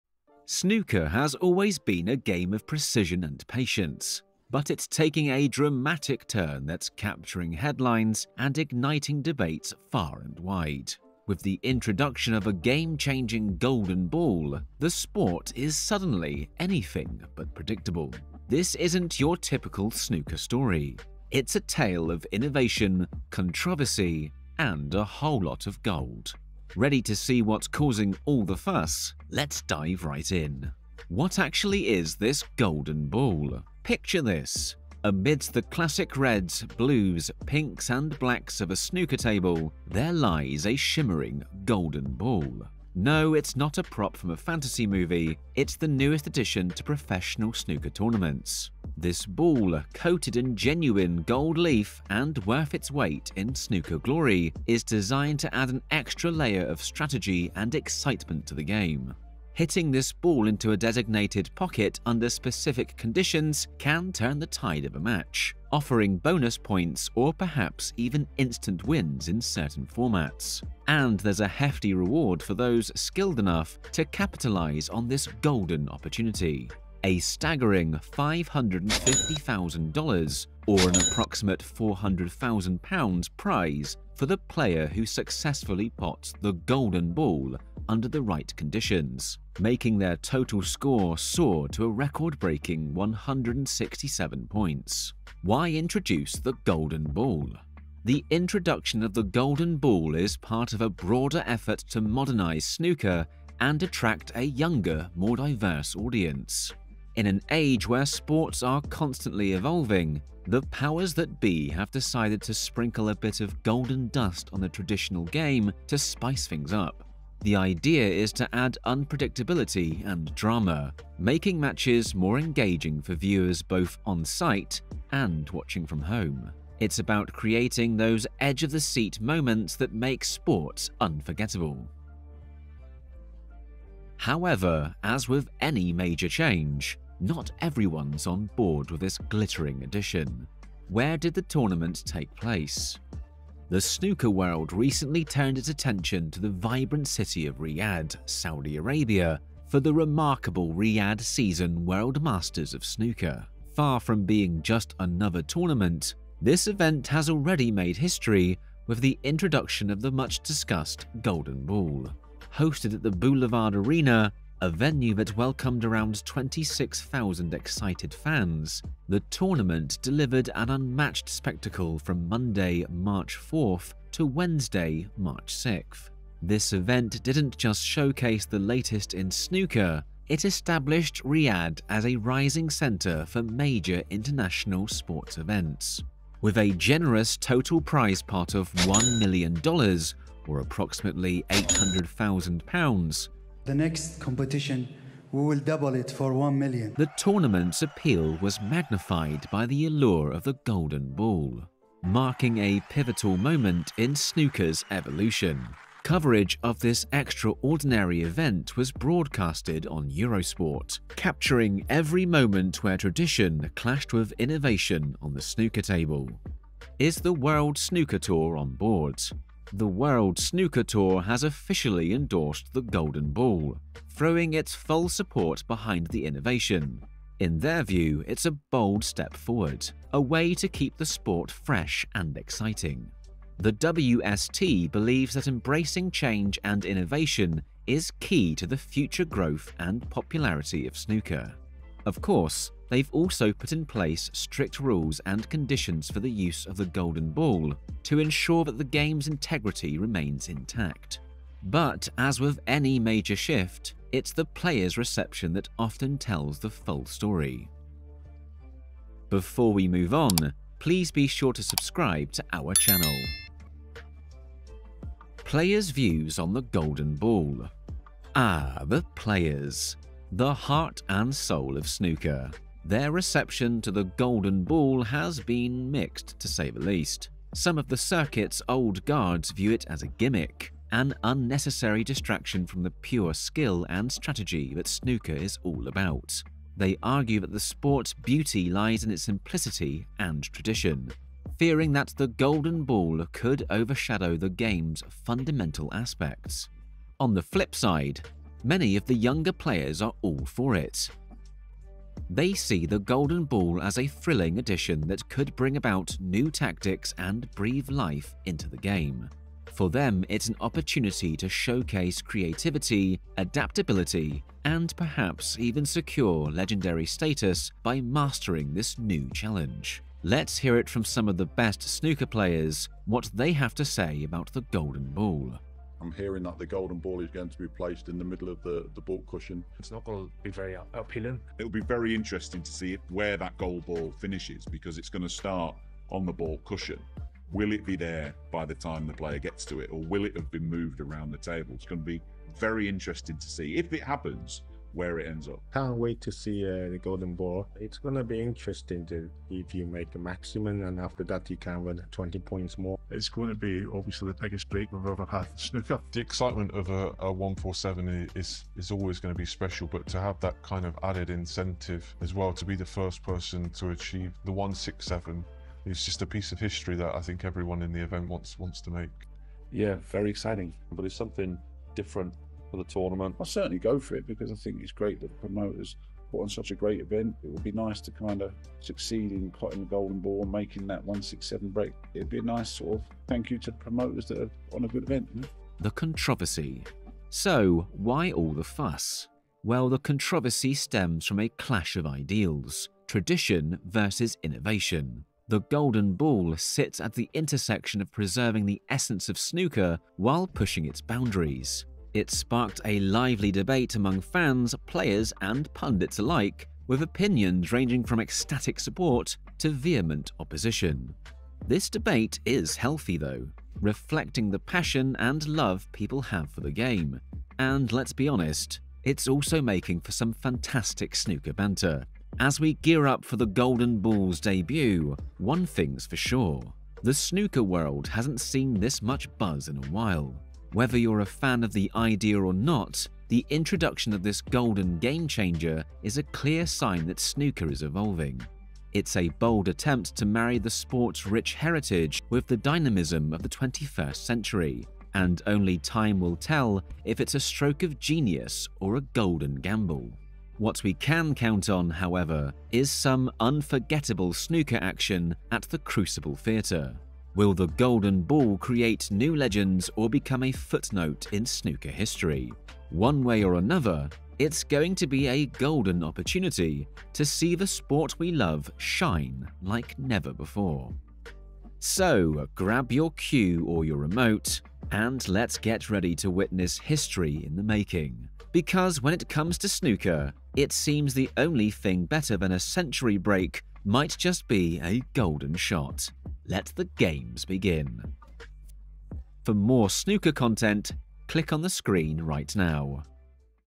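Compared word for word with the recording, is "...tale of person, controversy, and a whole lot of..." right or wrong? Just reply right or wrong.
wrong.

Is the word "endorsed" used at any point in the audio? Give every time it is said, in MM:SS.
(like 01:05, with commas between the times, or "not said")
03:42.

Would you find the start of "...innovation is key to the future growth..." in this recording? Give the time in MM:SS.
03:56.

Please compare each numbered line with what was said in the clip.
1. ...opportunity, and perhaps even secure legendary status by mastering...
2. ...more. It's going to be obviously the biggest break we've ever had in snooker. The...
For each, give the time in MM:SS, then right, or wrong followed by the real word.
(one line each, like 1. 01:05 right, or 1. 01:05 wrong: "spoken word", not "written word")
1. 05:13 wrong: "adaptability", not "opportunity"
2. 05:52 right.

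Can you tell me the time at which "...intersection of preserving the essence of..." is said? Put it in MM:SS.
06:37.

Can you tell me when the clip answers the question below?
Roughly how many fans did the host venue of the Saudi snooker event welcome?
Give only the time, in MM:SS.
02:46.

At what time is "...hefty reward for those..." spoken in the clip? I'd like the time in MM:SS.
01:11.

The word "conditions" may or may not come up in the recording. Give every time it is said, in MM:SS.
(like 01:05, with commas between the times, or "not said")
01:02, 01:28, 04:05.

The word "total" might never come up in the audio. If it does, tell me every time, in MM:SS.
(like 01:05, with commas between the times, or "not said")
01:30, 03:07.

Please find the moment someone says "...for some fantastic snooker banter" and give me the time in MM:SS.
07:00.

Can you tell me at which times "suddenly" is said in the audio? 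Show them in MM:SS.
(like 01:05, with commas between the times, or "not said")
00:15.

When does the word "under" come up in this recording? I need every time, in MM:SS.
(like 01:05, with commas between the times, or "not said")
01:02, 01:27.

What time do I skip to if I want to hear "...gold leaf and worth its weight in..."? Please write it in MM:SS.
00:51.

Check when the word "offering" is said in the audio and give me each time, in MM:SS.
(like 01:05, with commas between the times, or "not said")
01:05.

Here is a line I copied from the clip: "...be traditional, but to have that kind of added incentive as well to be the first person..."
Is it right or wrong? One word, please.
wrong.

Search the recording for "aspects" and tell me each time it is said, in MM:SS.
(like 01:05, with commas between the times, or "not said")
04:55.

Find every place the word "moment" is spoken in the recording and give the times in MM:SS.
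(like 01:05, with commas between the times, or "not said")
02:09, 03:23, 03:32.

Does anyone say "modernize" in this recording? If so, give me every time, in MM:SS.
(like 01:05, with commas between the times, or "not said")
01:42.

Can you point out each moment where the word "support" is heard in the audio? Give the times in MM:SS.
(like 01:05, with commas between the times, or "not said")
03:45, 06:48.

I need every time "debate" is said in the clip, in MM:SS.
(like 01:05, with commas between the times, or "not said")
00:09, 06:43, 06:51.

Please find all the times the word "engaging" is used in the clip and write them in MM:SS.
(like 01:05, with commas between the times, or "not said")
02:02.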